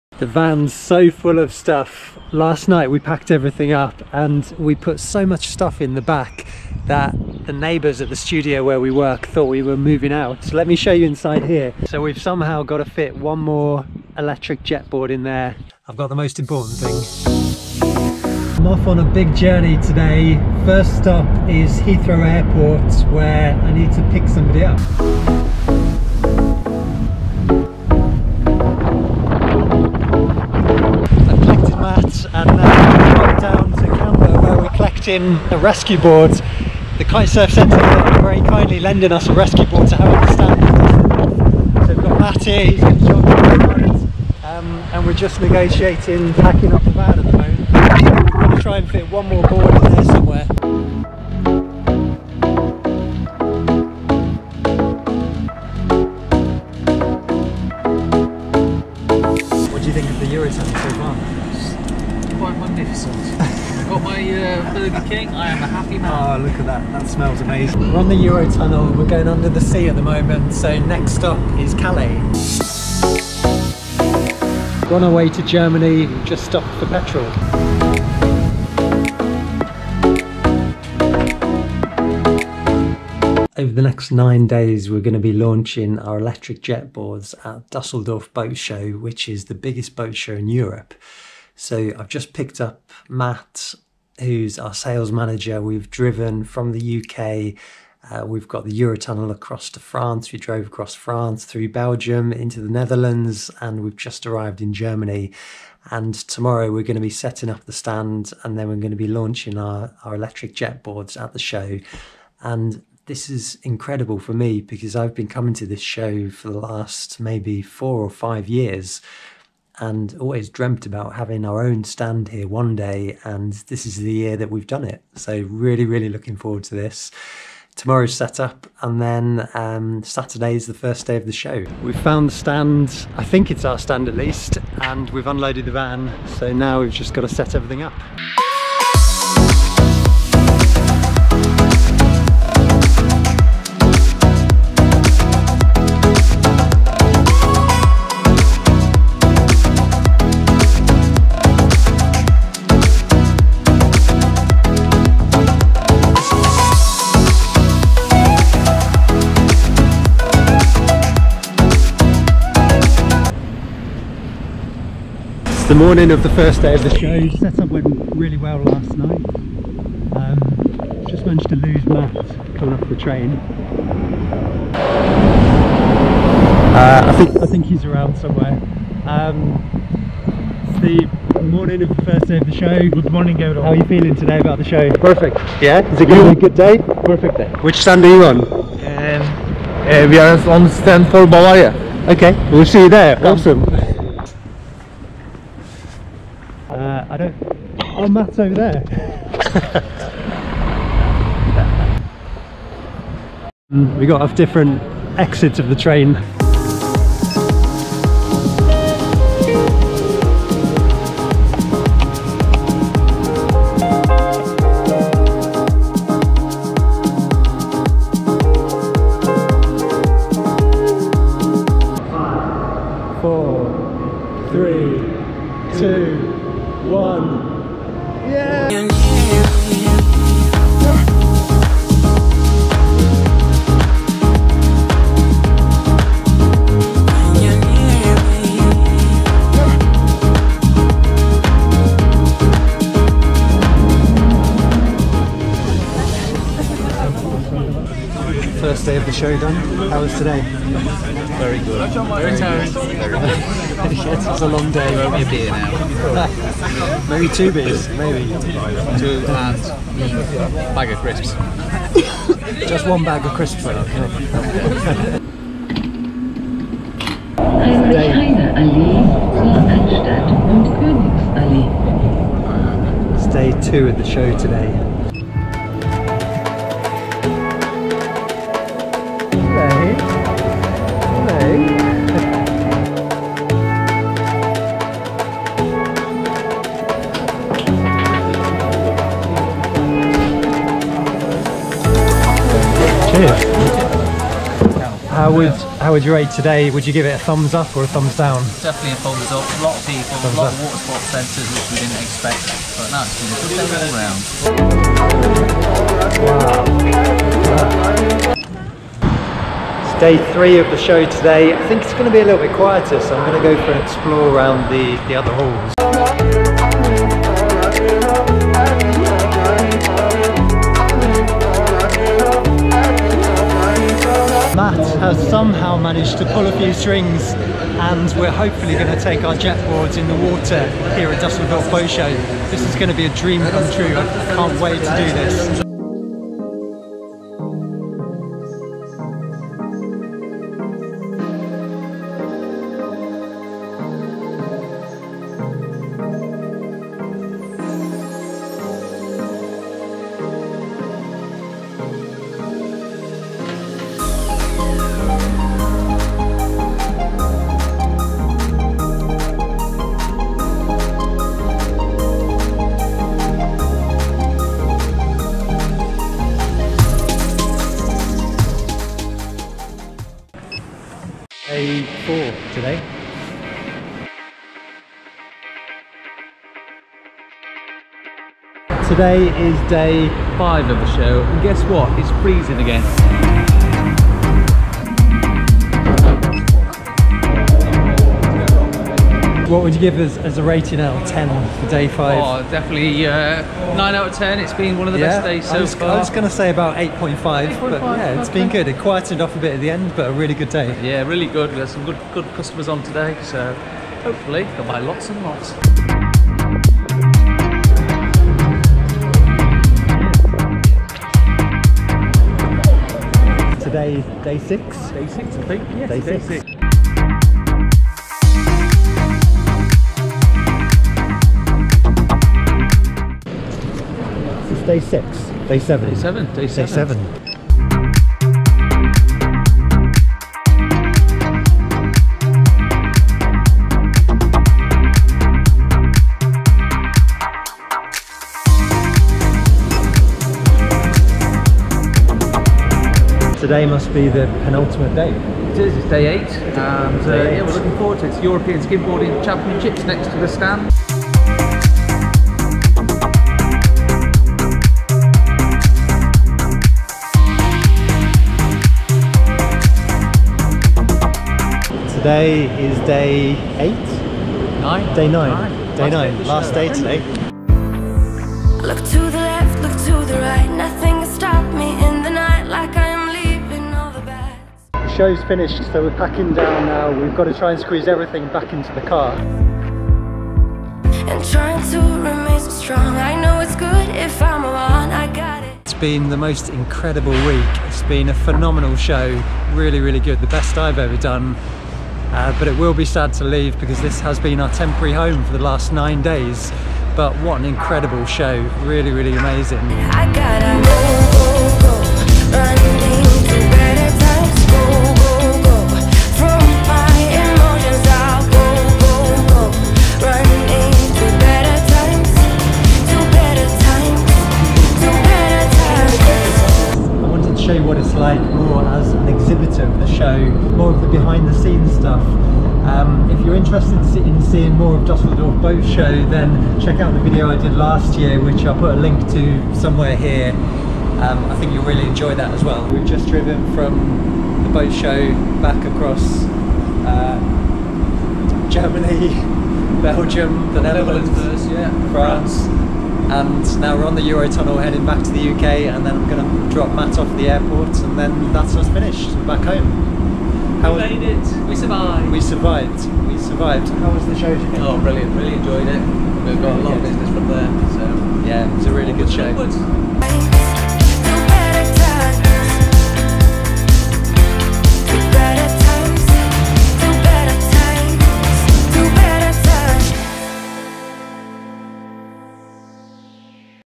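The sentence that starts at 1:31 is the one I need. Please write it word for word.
So I've just picked up Matt who's our sales manager.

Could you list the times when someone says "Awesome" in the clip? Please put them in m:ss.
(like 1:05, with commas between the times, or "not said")
3:13.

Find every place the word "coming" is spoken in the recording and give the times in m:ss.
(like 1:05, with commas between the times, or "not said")
1:55, 2:52.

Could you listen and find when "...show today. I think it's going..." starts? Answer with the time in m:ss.
5:10.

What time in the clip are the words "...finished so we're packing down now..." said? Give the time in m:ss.
7:55.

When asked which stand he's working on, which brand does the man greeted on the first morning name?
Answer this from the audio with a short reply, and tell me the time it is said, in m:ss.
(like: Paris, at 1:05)
Bavaria, at 3:11.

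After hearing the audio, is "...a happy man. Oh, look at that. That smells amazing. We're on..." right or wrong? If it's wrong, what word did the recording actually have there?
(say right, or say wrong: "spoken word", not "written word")
right.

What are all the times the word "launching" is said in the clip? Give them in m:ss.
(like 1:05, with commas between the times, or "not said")
1:25, 1:49.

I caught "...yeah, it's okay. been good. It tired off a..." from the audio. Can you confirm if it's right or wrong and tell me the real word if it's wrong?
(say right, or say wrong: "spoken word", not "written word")
wrong: "quietened", not "tired".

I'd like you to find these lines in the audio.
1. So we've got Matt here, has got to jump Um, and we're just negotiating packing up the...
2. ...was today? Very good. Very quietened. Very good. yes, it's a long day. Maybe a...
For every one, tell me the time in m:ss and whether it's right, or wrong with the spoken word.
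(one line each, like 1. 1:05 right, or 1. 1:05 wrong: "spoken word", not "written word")
1. 0:41 right
2. 4:10 wrong: "tired", not "quietened".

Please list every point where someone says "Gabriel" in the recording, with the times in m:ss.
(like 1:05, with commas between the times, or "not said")
3:03.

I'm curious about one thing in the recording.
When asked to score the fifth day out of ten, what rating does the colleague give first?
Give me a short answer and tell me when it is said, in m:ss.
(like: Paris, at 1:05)
9 out of 10, at 6:33.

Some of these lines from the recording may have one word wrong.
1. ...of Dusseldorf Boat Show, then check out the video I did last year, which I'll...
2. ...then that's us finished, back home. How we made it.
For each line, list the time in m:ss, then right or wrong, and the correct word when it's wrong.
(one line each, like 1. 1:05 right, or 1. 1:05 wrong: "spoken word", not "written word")
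1. 8:44 right
2. 9:07 right.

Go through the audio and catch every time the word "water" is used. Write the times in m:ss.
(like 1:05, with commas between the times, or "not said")
5:00, 5:30.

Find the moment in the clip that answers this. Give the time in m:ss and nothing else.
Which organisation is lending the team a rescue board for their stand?
0:36.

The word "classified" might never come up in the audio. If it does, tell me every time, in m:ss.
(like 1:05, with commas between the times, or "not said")
not said.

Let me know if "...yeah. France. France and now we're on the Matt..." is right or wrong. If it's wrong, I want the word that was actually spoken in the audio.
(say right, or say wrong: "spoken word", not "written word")
wrong: "Eurotunnel", not "Matt".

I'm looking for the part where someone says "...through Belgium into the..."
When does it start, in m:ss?
1:41.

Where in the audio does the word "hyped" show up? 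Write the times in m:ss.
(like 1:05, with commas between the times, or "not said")
not said.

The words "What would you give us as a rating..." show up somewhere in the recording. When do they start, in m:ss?
6:29.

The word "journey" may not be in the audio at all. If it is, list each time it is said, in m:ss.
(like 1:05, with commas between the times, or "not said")
0:19.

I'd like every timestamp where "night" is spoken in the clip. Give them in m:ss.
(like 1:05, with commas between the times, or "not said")
0:02, 2:48.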